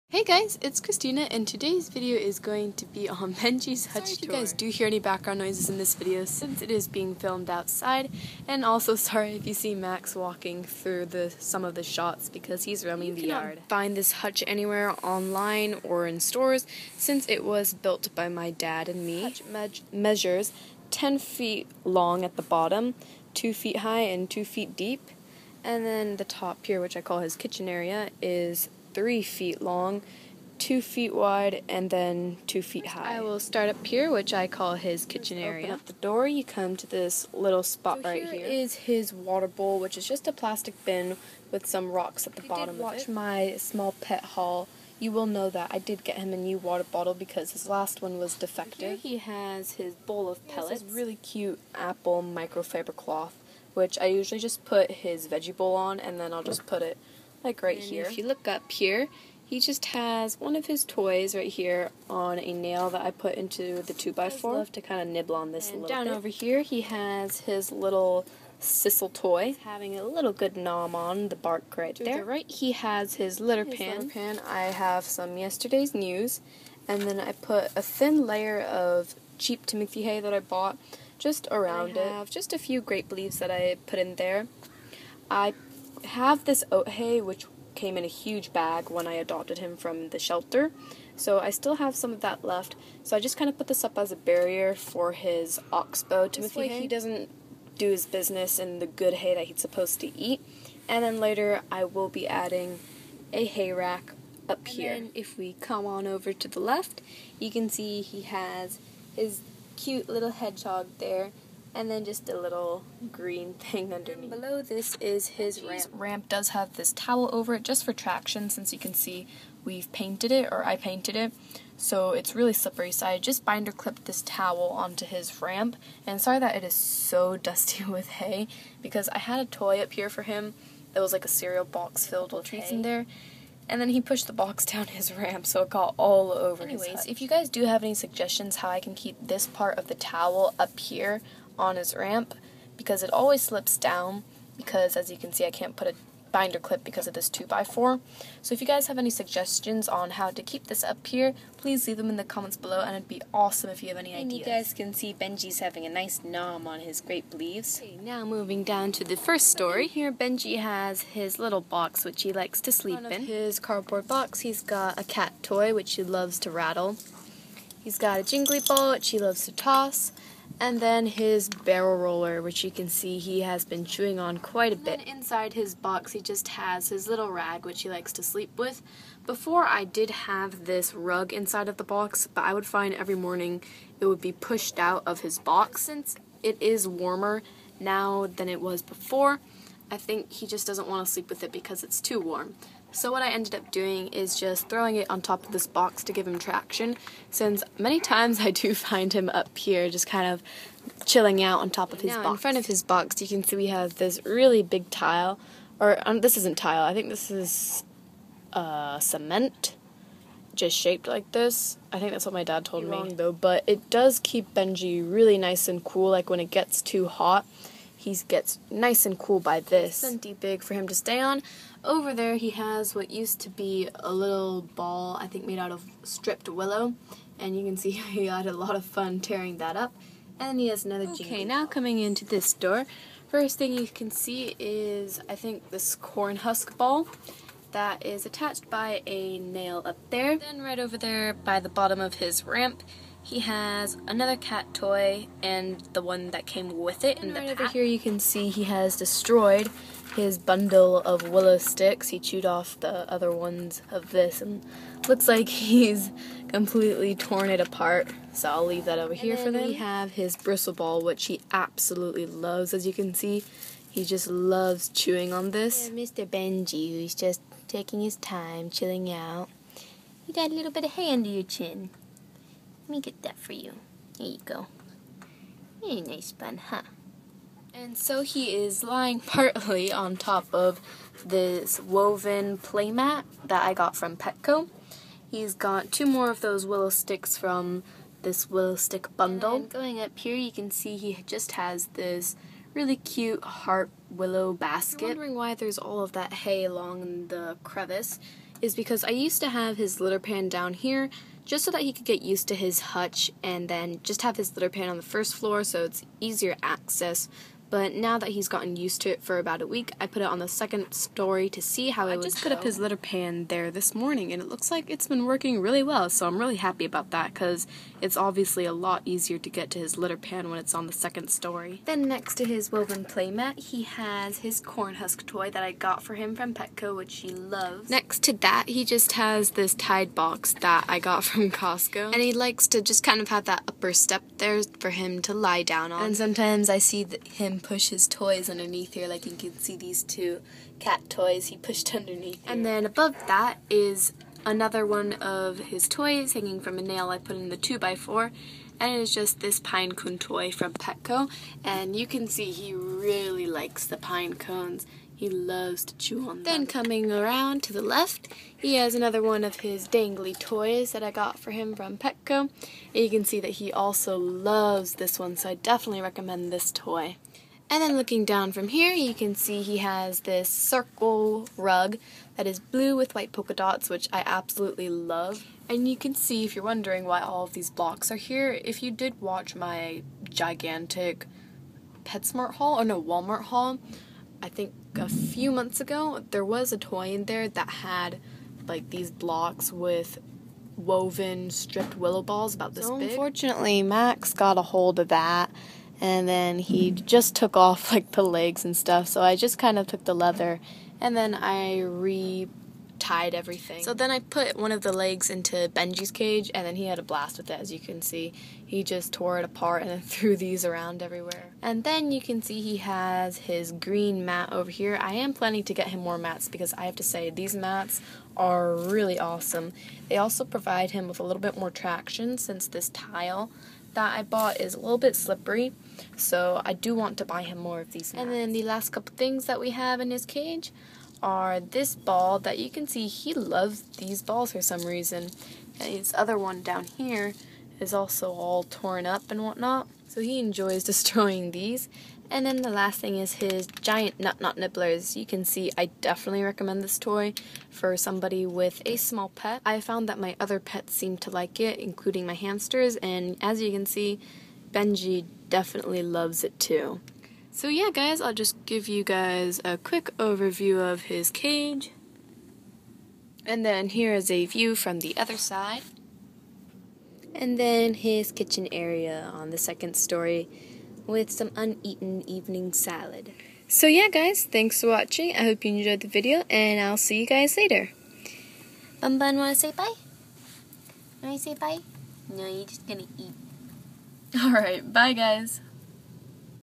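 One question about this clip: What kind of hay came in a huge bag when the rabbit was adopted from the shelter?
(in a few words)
oat hay.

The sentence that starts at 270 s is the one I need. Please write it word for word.
You got a little bit of hay under your chin me get that for you.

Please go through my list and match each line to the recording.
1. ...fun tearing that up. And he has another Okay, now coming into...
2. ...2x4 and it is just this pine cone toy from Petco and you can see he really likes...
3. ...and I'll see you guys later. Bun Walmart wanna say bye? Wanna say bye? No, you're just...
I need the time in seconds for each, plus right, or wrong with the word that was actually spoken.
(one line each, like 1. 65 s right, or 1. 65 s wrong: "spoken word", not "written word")
1. 228 s right
2. 347 s right
3. 476 s wrong: "Bun", not "Walmart".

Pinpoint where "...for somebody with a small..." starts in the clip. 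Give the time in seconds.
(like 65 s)
447 s.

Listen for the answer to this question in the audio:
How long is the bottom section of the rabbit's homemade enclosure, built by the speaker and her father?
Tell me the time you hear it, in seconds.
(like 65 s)
20 s.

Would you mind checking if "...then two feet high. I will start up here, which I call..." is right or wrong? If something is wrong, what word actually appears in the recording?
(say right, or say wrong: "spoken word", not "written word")
right.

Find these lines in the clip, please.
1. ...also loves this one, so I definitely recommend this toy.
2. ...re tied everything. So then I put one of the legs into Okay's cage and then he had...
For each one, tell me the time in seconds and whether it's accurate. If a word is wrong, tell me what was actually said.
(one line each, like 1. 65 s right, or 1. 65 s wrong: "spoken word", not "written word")
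1. 363 s right
2. 401 s wrong: "Benji", not "Okay".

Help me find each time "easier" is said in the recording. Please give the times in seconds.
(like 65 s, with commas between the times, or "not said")
306 s, 319 s.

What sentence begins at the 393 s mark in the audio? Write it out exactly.
Unfortunately, Max got a hold of that and then he just took off like the legs and stuff.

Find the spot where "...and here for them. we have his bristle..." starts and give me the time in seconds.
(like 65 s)
259 s.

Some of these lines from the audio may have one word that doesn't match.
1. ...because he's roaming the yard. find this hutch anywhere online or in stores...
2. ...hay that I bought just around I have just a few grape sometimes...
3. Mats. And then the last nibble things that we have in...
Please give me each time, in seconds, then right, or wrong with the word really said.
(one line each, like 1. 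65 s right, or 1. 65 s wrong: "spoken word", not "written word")
1. 12 s right
2. 80 s wrong: "leaves", not "sometimes"
3. 428 s wrong: "couple", not "nibble".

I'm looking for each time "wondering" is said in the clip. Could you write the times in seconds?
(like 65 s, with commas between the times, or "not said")
295 s, 376 s.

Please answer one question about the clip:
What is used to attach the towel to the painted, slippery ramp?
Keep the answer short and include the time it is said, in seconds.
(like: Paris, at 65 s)
binder clip, at 123 s.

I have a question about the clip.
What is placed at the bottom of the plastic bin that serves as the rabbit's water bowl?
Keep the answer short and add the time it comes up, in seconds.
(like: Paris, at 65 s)
rocks, at 41 s.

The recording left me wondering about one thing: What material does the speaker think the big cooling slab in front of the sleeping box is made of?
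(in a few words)
cement.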